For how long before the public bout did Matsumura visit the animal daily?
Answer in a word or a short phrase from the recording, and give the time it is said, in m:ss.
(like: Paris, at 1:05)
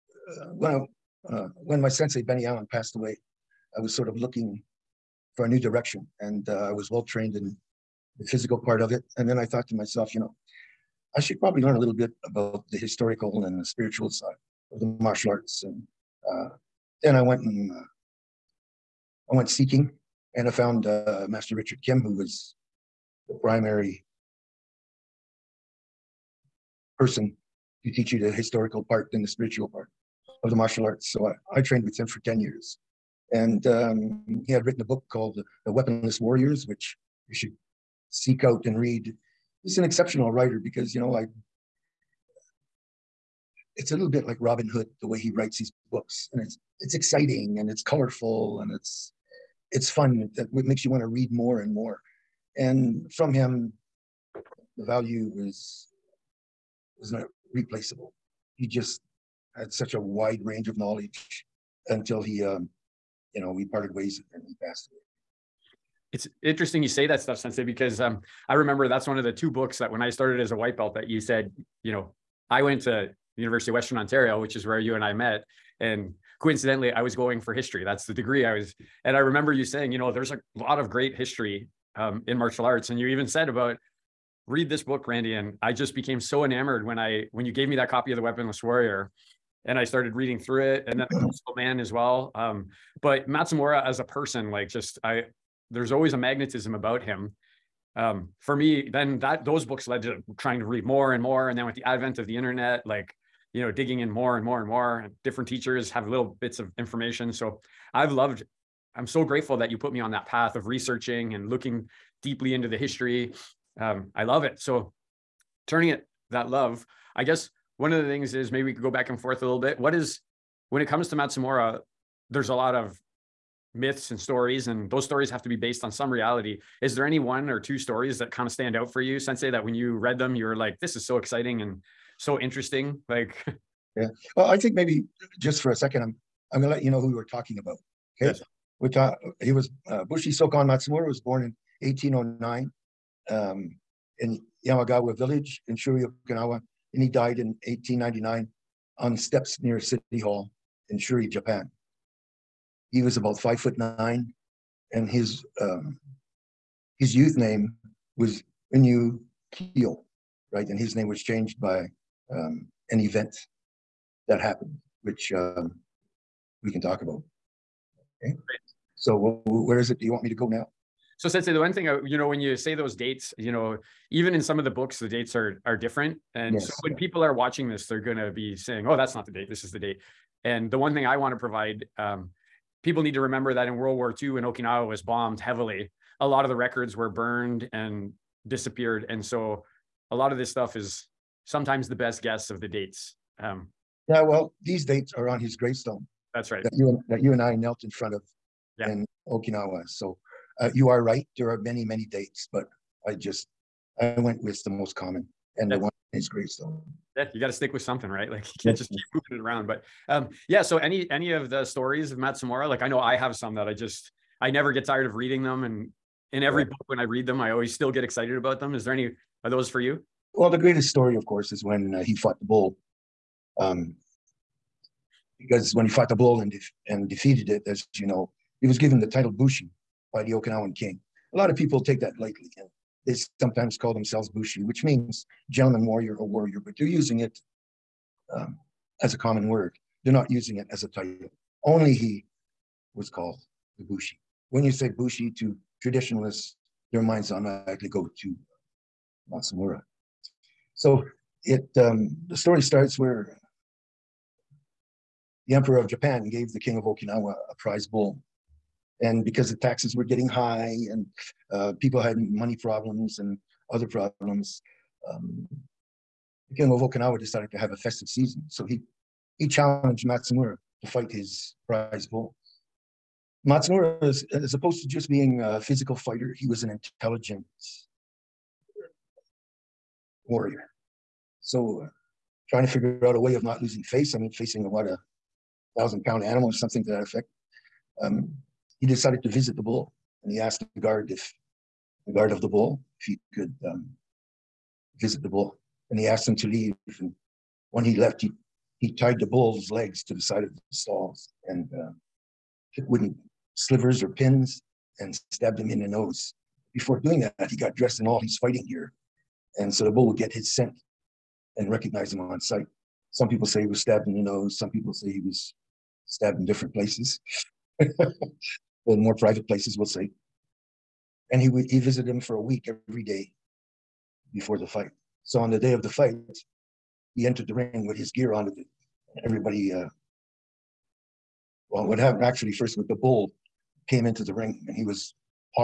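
a week, at 5:22.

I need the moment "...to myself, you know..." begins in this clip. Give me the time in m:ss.
0:09.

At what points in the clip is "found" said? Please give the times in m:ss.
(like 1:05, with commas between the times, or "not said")
0:20.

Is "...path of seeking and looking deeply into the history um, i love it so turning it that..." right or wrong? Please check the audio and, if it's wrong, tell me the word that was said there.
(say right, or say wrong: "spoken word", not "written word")
wrong: "researching", not "seeking".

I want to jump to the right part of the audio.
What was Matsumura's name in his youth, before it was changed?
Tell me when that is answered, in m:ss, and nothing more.
2:38.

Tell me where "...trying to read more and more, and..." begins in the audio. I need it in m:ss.
1:40.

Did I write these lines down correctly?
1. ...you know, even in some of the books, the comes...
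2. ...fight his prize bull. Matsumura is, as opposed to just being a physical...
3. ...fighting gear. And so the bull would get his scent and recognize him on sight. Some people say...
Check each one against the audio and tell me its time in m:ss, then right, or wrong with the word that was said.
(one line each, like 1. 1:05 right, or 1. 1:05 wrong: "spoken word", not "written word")
1. 2:53 wrong: "dates", not "comes"
2. 4:30 right
3. 5:08 right.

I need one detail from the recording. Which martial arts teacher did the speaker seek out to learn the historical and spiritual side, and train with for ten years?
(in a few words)
Richard Kim.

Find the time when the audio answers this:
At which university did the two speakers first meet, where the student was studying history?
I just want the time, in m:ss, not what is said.
1:13.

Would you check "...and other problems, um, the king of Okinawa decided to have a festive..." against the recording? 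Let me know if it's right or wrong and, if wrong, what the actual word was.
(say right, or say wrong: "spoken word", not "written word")
right.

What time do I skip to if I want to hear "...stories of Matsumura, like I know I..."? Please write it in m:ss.
3:31.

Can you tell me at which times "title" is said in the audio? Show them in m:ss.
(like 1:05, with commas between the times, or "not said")
3:49, 4:00.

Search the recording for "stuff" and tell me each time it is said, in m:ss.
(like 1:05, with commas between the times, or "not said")
1:07, 3:10.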